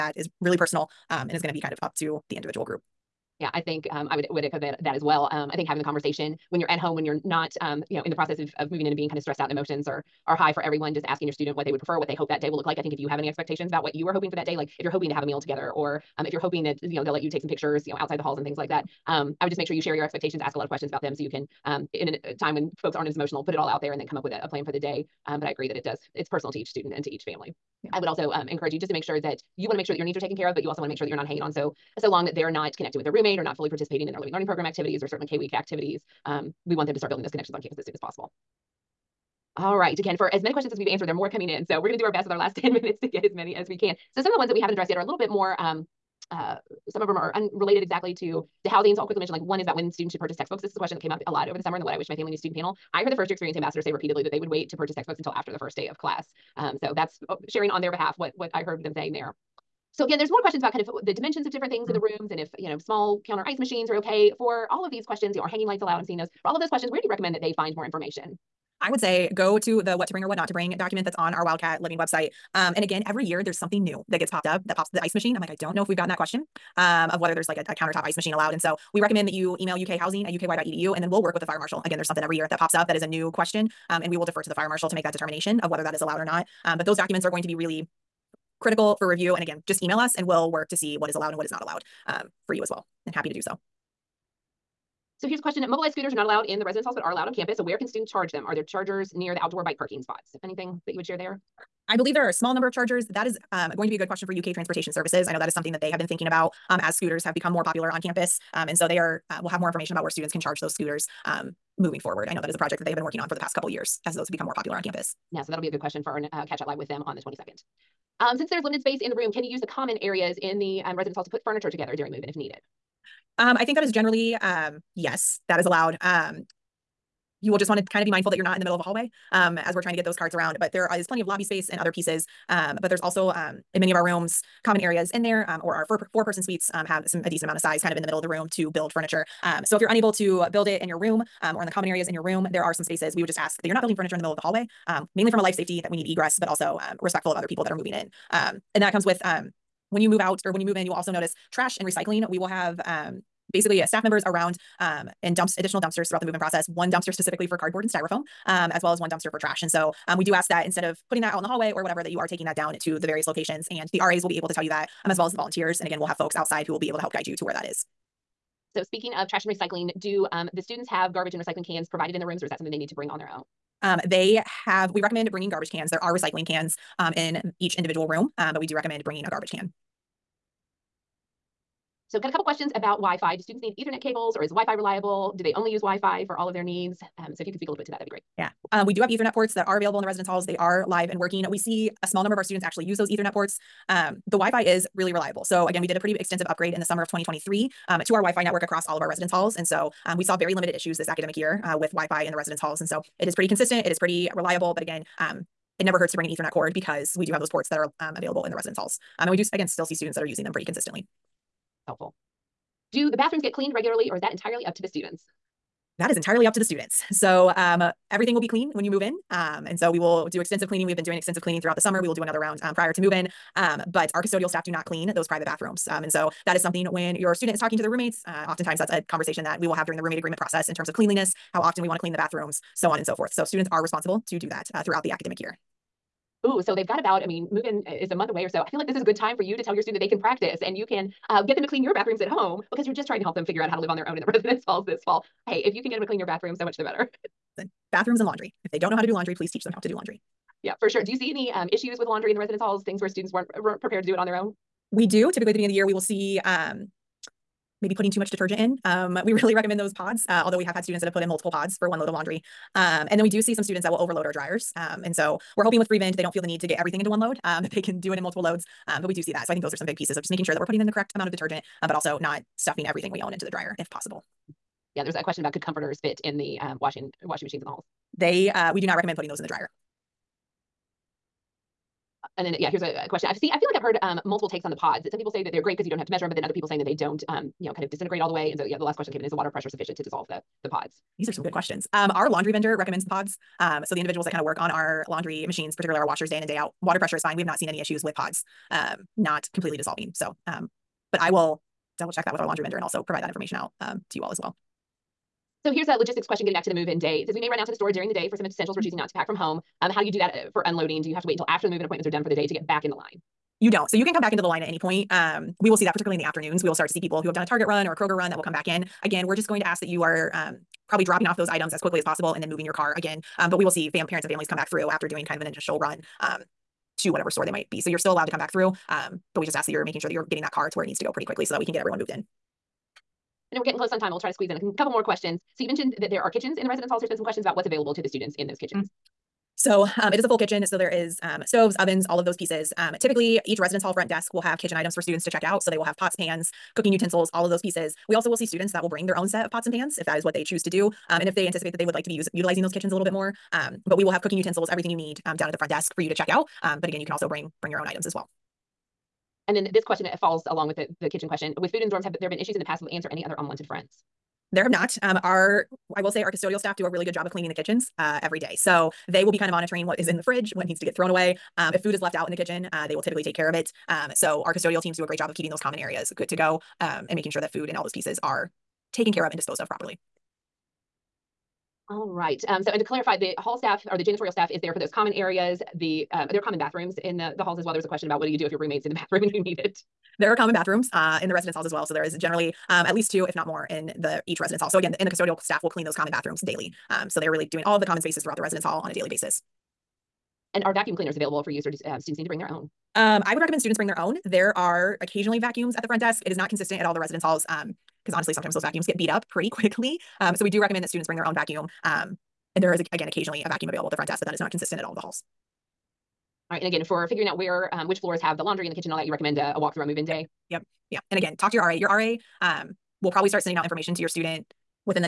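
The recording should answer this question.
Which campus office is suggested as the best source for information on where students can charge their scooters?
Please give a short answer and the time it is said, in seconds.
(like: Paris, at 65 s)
UK Transportation Services, at 104 s.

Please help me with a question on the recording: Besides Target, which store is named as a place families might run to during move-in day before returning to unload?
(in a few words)
Kroger.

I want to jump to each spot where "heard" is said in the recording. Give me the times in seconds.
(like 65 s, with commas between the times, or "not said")
53 s, 58 s, 283 s.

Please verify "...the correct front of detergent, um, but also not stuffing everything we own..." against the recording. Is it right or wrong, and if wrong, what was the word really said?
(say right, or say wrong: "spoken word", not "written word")
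wrong: "amount", not "front".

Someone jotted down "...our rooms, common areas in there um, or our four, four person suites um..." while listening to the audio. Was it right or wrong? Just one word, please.
right.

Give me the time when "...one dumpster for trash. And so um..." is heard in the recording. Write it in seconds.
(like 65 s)
158 s.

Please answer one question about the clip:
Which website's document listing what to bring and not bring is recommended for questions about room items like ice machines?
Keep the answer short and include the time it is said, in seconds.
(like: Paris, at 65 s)
Wildcat Living, at 71 s.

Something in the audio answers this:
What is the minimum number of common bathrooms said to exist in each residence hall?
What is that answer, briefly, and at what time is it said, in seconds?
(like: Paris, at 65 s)
2, at 393 s.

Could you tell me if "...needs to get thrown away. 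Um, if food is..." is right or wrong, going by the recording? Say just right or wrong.
right.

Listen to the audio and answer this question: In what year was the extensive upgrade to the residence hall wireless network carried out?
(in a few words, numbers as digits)
2023.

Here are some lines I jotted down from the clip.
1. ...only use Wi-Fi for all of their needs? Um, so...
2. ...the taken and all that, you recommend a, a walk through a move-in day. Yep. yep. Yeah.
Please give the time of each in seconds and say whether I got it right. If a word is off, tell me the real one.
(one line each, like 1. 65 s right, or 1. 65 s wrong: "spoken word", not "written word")
1. 185 s right
2. 418 s wrong: "kitchen", not "taken".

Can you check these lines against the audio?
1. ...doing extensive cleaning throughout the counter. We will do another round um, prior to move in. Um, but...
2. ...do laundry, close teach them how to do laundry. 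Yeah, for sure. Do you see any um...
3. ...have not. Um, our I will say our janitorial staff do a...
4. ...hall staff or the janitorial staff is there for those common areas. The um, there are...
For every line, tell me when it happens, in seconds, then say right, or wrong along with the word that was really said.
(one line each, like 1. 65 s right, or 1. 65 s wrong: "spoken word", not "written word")
1. 221 s wrong: "summer", not "counter"
2. 249 s wrong: "please", not "close"
3. 364 s wrong: "custodial", not "janitorial"
4. 383 s right.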